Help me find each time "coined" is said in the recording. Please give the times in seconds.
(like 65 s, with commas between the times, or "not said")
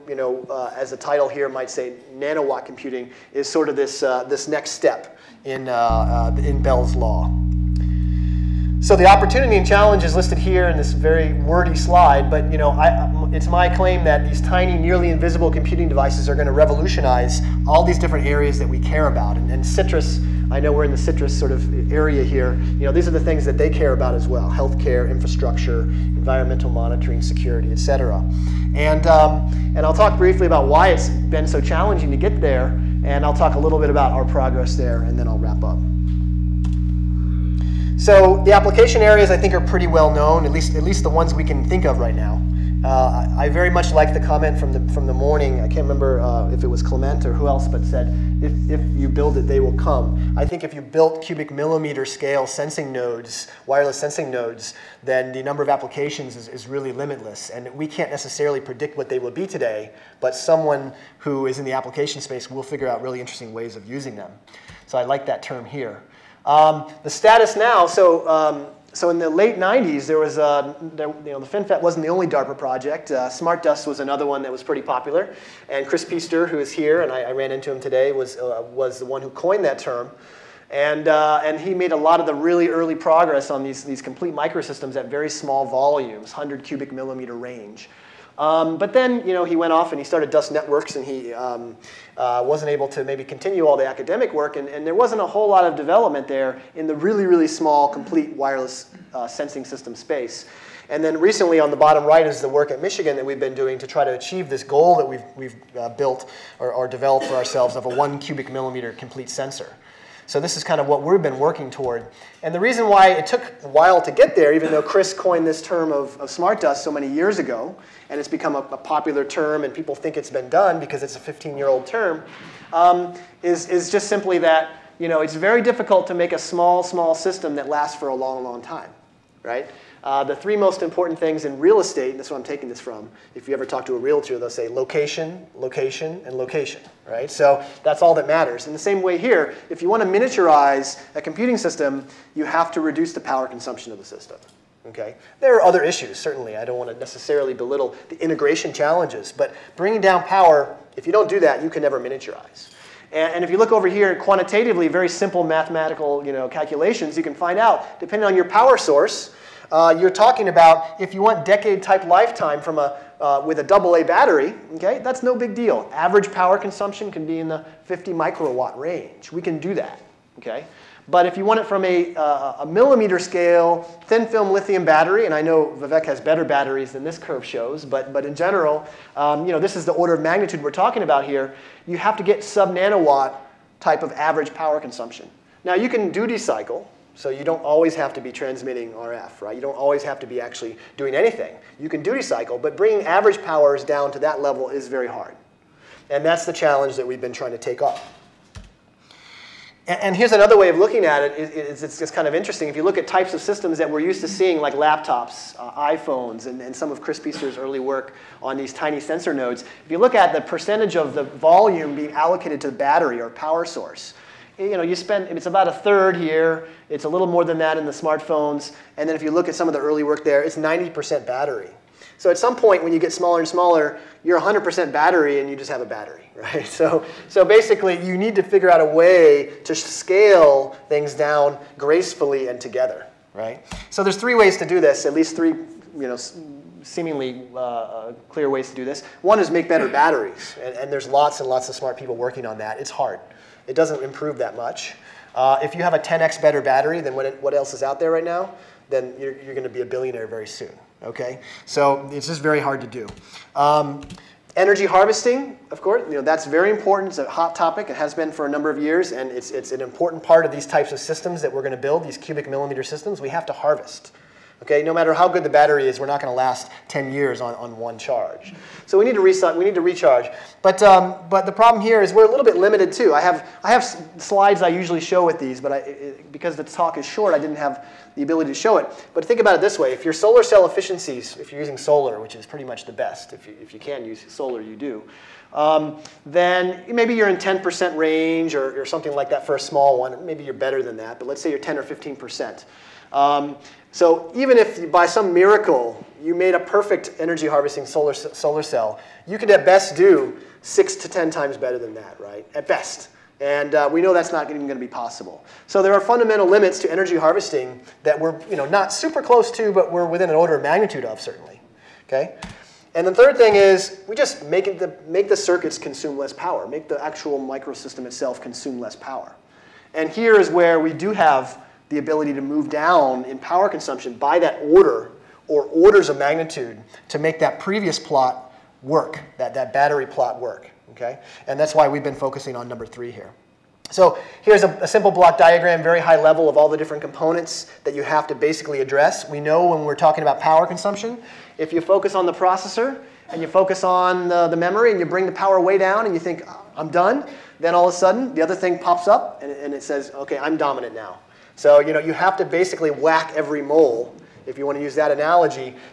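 79 s, 115 s.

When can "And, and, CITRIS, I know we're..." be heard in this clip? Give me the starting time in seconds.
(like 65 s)
19 s.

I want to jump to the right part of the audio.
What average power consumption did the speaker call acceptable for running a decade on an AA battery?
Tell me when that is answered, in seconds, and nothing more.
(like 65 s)
167 s.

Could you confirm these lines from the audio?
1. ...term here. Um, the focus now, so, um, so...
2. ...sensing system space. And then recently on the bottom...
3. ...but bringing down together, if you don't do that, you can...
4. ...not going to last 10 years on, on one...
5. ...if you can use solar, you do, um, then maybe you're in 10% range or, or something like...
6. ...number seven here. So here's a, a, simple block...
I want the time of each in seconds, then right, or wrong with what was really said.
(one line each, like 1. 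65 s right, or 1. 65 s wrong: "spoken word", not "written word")
1. 65 s wrong: "status", not "focus"
2. 99 s right
3. 149 s wrong: "power", not "together"
4. 266 s right
5. 283 s right
6. 332 s wrong: "three", not "seven".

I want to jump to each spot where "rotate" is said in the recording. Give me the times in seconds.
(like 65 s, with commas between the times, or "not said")
not said.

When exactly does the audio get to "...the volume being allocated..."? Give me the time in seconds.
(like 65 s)
211 s.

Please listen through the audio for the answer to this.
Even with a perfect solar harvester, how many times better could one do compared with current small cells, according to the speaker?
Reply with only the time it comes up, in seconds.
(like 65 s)
300 s.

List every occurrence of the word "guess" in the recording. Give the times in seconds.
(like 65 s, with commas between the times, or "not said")
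not said.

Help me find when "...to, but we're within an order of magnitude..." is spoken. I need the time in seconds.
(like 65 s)
309 s.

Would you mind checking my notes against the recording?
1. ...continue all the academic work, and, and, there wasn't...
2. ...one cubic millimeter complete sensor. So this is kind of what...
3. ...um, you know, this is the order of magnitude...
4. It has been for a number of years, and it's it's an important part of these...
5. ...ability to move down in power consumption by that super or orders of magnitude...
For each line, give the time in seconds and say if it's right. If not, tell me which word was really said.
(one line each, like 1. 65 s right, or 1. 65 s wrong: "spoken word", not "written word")
1. 93 s right
2. 107 s right
3. 179 s right
4. 257 s right
5. 321 s wrong: "order", not "super".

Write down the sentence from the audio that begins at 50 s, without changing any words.
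I think if you built cubic millimeter scale sensing nodes, wireless sensing nodes, then the number of applications is, is really limitless.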